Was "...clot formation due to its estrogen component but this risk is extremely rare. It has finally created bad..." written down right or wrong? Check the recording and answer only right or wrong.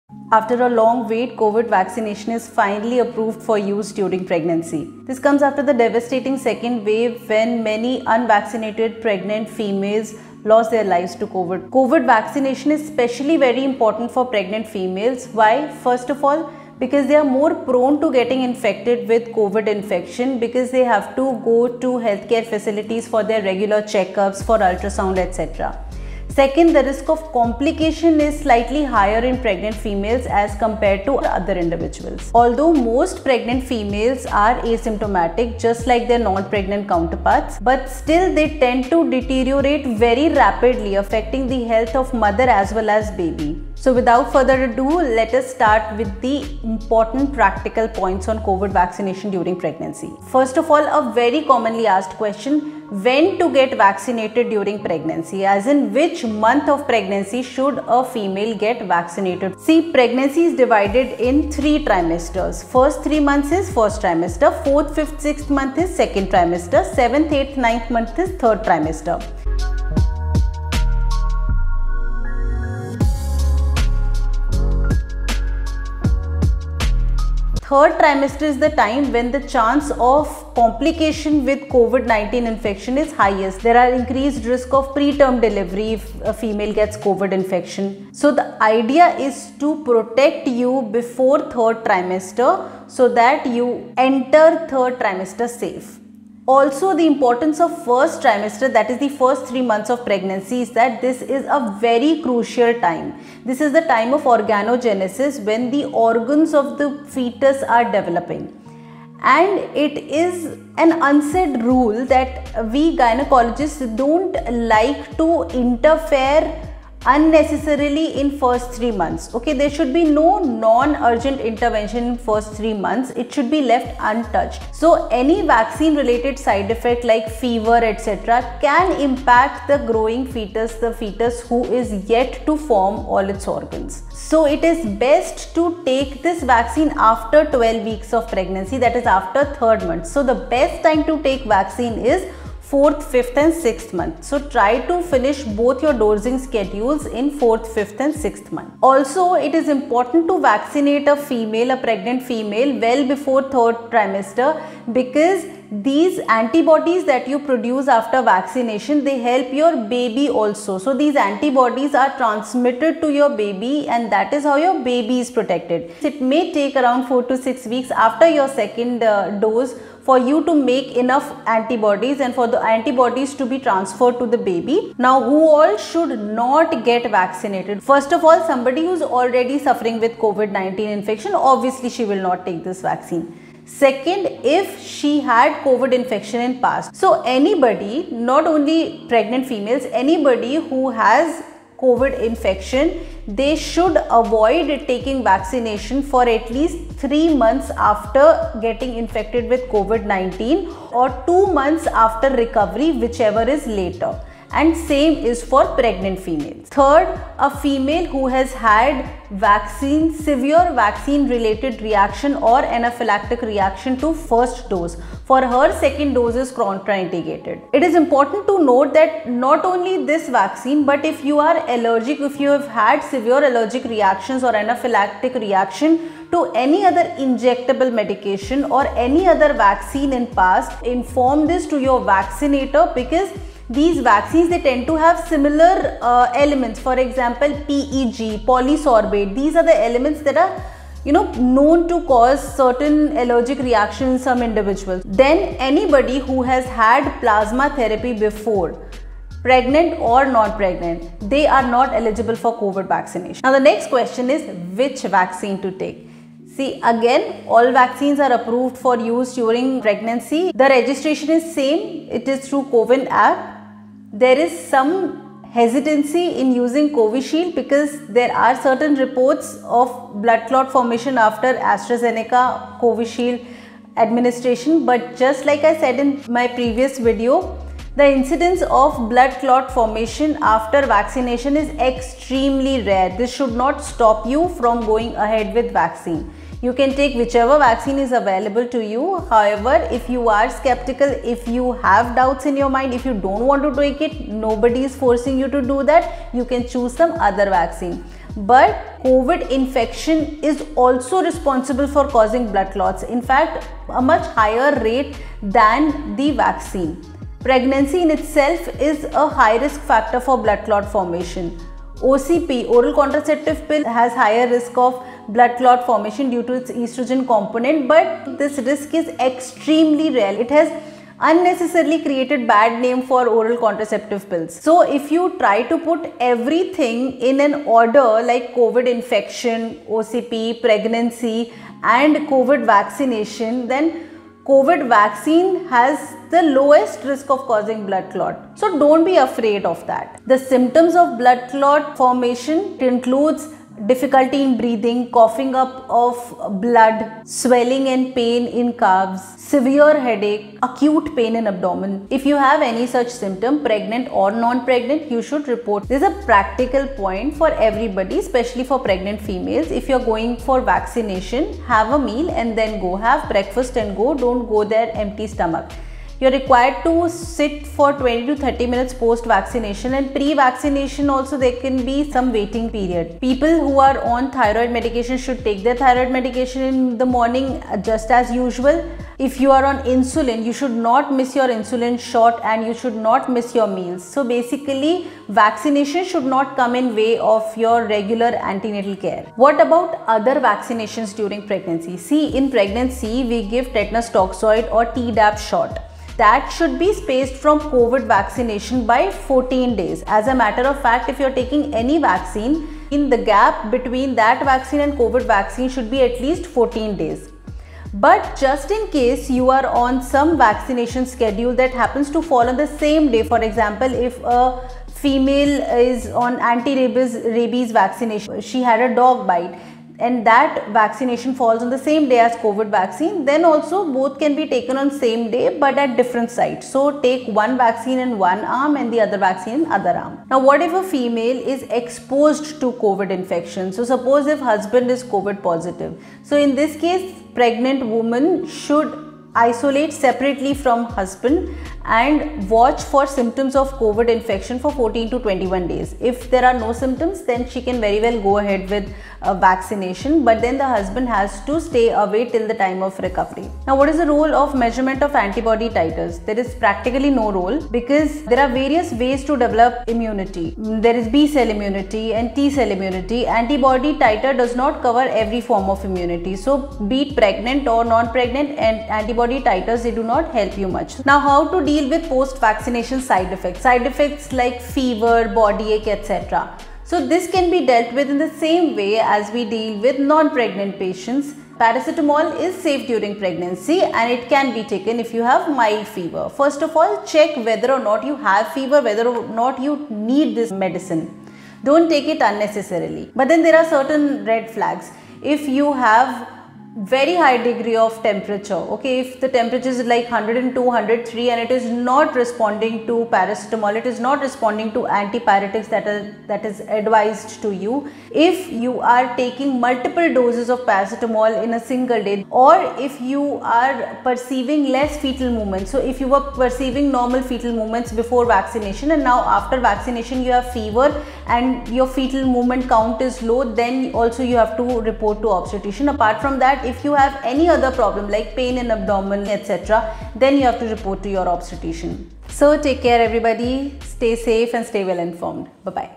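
wrong.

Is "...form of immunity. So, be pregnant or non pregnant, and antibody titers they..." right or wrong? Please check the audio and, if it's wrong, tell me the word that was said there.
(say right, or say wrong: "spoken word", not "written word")
right.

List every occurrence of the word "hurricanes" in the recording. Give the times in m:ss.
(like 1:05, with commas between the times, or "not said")
not said.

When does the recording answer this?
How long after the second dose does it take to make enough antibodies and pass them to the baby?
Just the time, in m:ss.
2:47.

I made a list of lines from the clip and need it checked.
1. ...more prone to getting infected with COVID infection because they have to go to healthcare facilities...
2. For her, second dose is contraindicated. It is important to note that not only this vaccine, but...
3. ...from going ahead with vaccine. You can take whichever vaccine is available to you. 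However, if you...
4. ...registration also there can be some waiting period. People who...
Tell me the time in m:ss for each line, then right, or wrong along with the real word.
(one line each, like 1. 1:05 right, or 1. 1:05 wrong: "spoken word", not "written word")
1. 0:17 right
2. 3:35 right
3. 4:44 right
4. 6:10 wrong: "vaccination", not "registration".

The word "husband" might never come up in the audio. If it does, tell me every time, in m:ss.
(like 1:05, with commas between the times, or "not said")
7:14, 7:20, 7:30.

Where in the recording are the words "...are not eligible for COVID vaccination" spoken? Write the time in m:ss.
4:11.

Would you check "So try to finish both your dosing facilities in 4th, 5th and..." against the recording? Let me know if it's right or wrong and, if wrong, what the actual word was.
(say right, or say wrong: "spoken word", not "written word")
wrong: "schedules", not "facilities".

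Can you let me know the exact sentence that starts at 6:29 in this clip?
What about other vaccinations during pregnancy?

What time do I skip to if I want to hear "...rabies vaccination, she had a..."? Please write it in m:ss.
6:57.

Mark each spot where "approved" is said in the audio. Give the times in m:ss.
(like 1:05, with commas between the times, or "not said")
0:02, 4:18.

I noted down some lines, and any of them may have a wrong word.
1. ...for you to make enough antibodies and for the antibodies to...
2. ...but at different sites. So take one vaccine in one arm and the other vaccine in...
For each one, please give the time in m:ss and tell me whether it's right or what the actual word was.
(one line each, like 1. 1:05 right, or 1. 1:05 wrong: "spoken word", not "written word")
1. 2:50 right
2. 7:05 right.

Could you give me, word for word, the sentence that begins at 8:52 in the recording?
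So take care everybody, stay safe and stay well informed.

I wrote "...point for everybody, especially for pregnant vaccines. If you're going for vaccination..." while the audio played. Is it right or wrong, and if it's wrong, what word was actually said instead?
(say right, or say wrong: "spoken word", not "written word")
wrong: "females", not "vaccines".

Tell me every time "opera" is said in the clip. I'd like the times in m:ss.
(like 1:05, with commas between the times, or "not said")
not said.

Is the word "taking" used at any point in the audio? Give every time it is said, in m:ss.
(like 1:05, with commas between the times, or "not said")
3:14, 6:41, 8:29.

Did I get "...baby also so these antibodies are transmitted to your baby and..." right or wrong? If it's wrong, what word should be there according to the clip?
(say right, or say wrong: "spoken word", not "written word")
right.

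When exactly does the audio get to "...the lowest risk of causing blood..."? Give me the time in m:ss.
5:36.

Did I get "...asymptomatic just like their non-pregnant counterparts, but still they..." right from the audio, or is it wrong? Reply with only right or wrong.
right.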